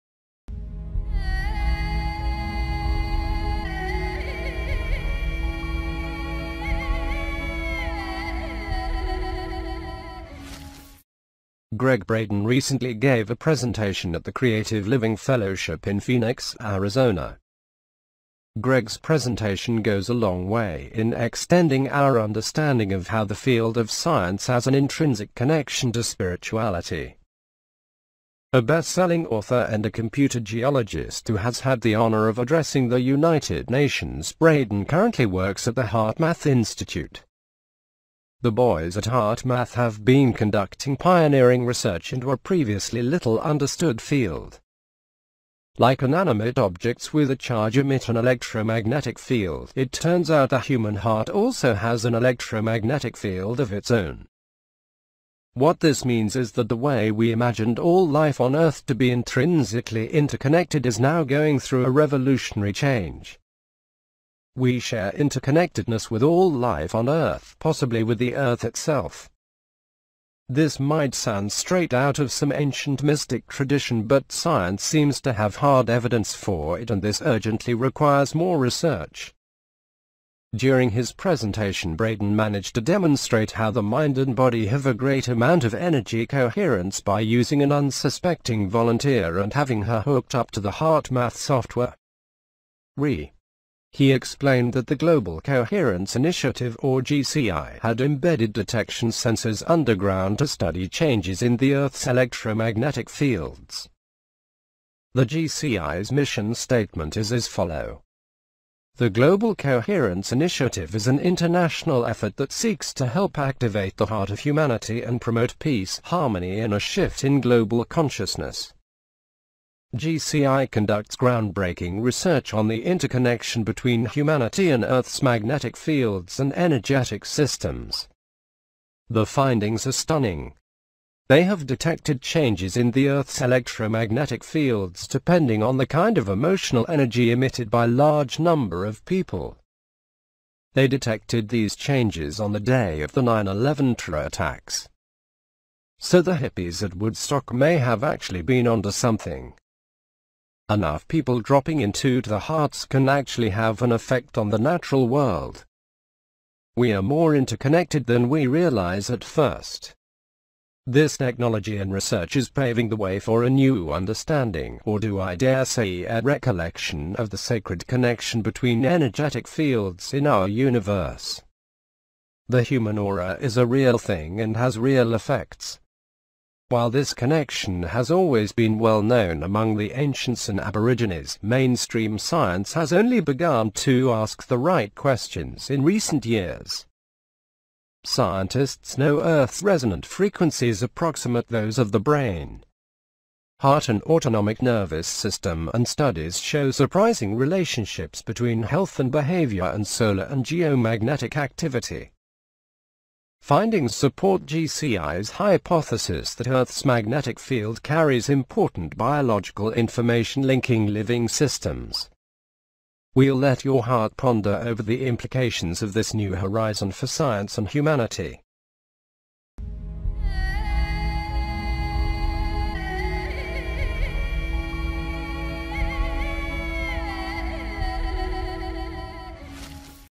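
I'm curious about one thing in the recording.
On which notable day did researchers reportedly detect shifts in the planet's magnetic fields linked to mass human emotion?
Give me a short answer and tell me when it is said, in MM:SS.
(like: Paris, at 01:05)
9-11, at 02:23.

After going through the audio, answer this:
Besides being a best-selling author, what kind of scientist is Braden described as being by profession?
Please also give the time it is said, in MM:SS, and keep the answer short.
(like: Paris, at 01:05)
Computer geologist, at 00:29.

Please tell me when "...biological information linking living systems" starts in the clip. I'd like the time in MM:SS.
03:28.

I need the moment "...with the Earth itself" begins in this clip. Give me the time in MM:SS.
01:08.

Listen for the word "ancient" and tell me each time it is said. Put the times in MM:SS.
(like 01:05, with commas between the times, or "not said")
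01:12, 02:59.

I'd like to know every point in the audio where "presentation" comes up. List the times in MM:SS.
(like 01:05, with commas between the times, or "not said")
00:13, 00:18, 01:21.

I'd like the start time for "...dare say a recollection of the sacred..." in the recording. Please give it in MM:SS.
02:45.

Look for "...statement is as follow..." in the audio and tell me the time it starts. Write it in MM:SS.
01:46.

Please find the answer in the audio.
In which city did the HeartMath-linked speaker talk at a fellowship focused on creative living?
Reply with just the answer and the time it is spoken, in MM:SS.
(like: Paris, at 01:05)
Phoenix, Arizona, at 00:16.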